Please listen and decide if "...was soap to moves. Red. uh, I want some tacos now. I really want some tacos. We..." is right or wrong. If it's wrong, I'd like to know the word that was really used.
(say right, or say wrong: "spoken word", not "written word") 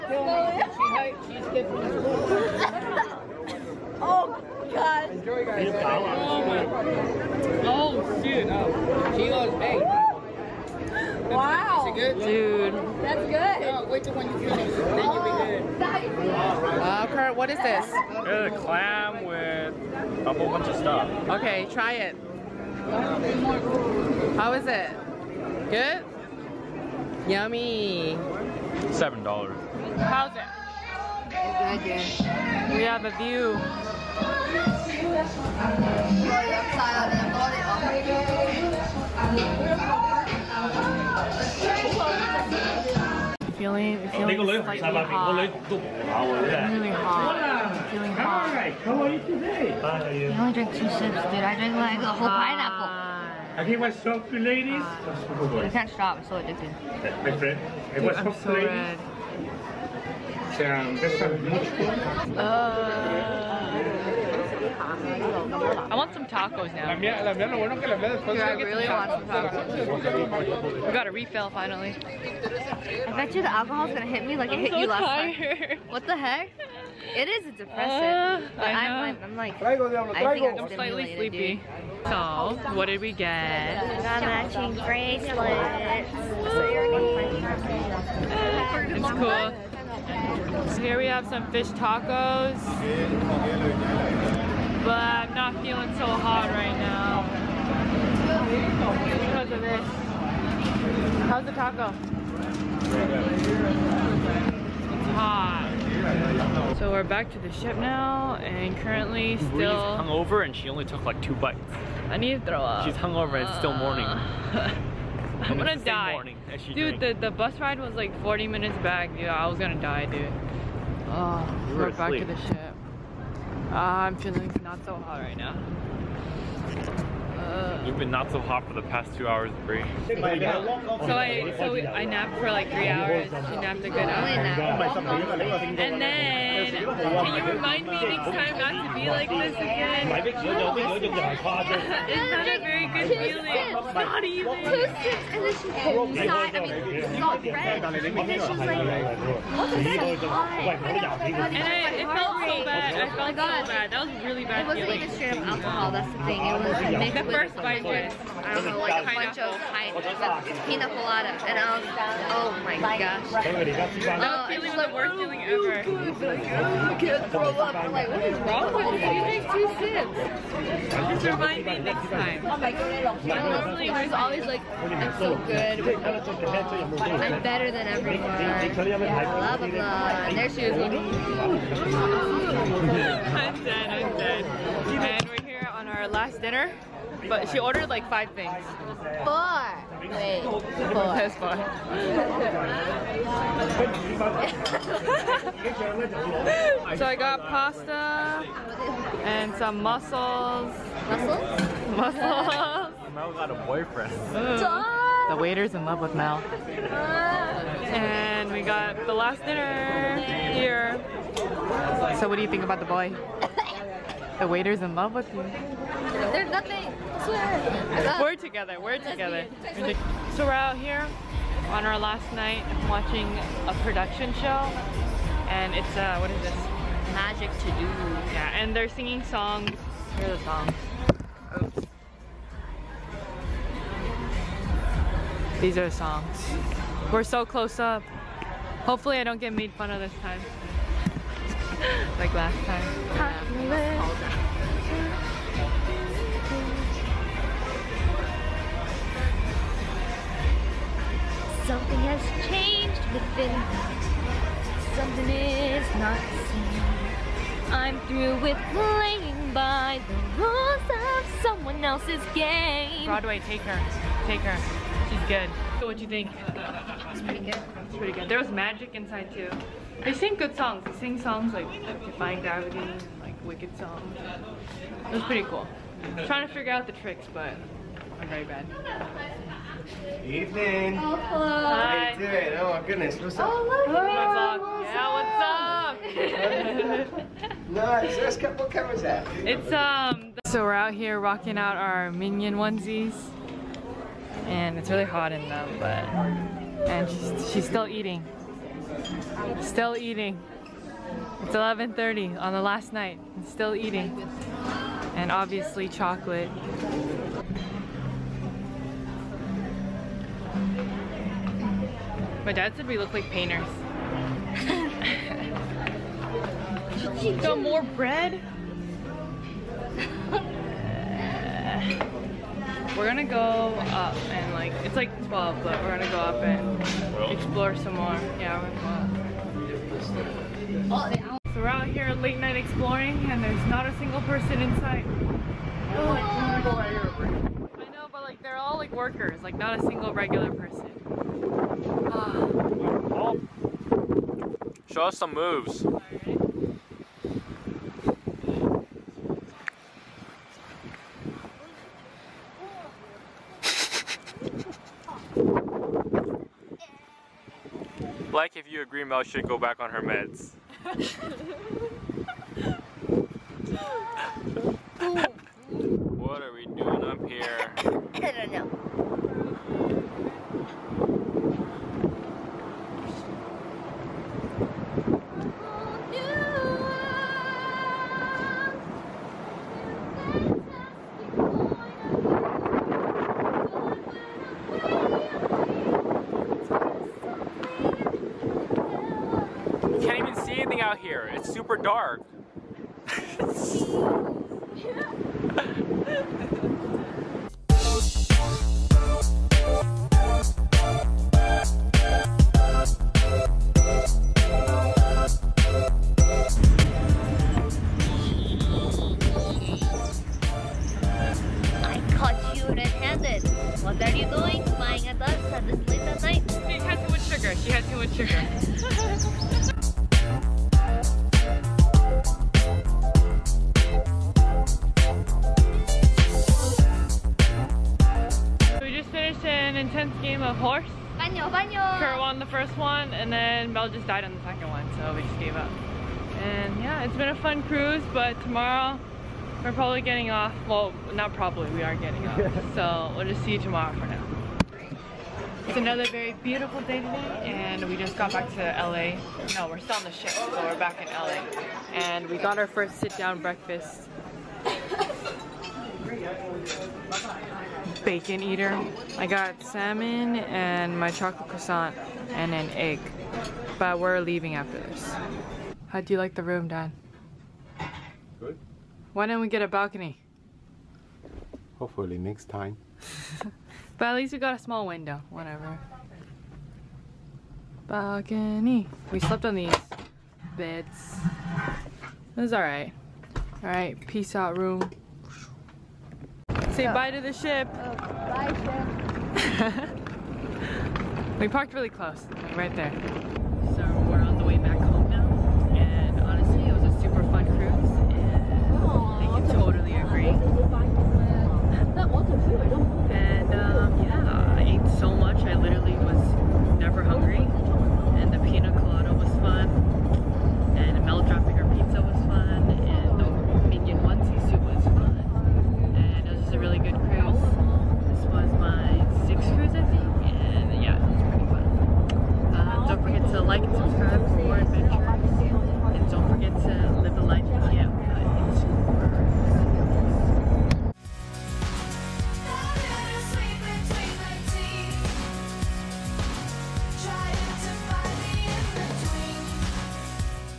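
wrong: "ladies", not "moves".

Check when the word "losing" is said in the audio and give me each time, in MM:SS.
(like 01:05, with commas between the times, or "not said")
not said.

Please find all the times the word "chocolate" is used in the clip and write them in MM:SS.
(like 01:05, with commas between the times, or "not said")
05:05, 07:41.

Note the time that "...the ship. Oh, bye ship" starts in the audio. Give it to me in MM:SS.
08:07.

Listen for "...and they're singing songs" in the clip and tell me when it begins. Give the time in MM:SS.
03:48.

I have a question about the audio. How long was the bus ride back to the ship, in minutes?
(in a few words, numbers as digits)
40.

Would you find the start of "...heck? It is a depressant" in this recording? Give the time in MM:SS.
01:16.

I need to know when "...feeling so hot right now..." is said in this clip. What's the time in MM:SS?
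01:35.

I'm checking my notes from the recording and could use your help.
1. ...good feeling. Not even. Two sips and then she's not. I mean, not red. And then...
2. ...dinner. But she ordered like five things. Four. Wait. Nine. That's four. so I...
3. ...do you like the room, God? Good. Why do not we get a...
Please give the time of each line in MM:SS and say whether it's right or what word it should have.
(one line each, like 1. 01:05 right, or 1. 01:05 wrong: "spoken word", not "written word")
1. 02:22 right
2. 03:06 wrong: "Four", not "Nine"
3. 07:46 wrong: "Dad", not "God".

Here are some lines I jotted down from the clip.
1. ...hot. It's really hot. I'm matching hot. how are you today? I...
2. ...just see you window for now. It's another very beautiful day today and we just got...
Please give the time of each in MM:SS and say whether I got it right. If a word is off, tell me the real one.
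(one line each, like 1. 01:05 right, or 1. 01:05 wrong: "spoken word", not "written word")
1. 00:44 wrong: "feeling", not "matching"
2. 07:23 wrong: "tomorrow", not "window".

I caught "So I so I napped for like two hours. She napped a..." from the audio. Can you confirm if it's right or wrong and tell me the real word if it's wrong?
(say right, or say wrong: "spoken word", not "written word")
wrong: "three", not "two".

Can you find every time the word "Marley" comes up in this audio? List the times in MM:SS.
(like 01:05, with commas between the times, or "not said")
not said.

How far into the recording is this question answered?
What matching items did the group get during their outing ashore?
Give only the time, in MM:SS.
01:24.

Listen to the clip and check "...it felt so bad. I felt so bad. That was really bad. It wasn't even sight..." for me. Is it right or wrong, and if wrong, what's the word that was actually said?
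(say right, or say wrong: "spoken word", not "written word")
wrong: "straight", not "sight".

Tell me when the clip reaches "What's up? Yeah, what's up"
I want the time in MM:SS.
04:45.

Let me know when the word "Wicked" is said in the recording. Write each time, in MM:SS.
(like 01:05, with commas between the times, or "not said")
04:33.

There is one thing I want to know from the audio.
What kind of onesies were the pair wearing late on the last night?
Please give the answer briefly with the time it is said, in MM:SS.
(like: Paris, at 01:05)
Minion, at 04:52.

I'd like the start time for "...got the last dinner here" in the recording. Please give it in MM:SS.
03:28.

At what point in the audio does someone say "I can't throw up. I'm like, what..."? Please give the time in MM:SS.
02:45.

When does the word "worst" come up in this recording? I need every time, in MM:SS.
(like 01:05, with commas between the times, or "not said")
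02:44.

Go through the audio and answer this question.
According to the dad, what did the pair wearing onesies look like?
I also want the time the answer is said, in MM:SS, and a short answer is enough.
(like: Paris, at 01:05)
Painters, at 05:13.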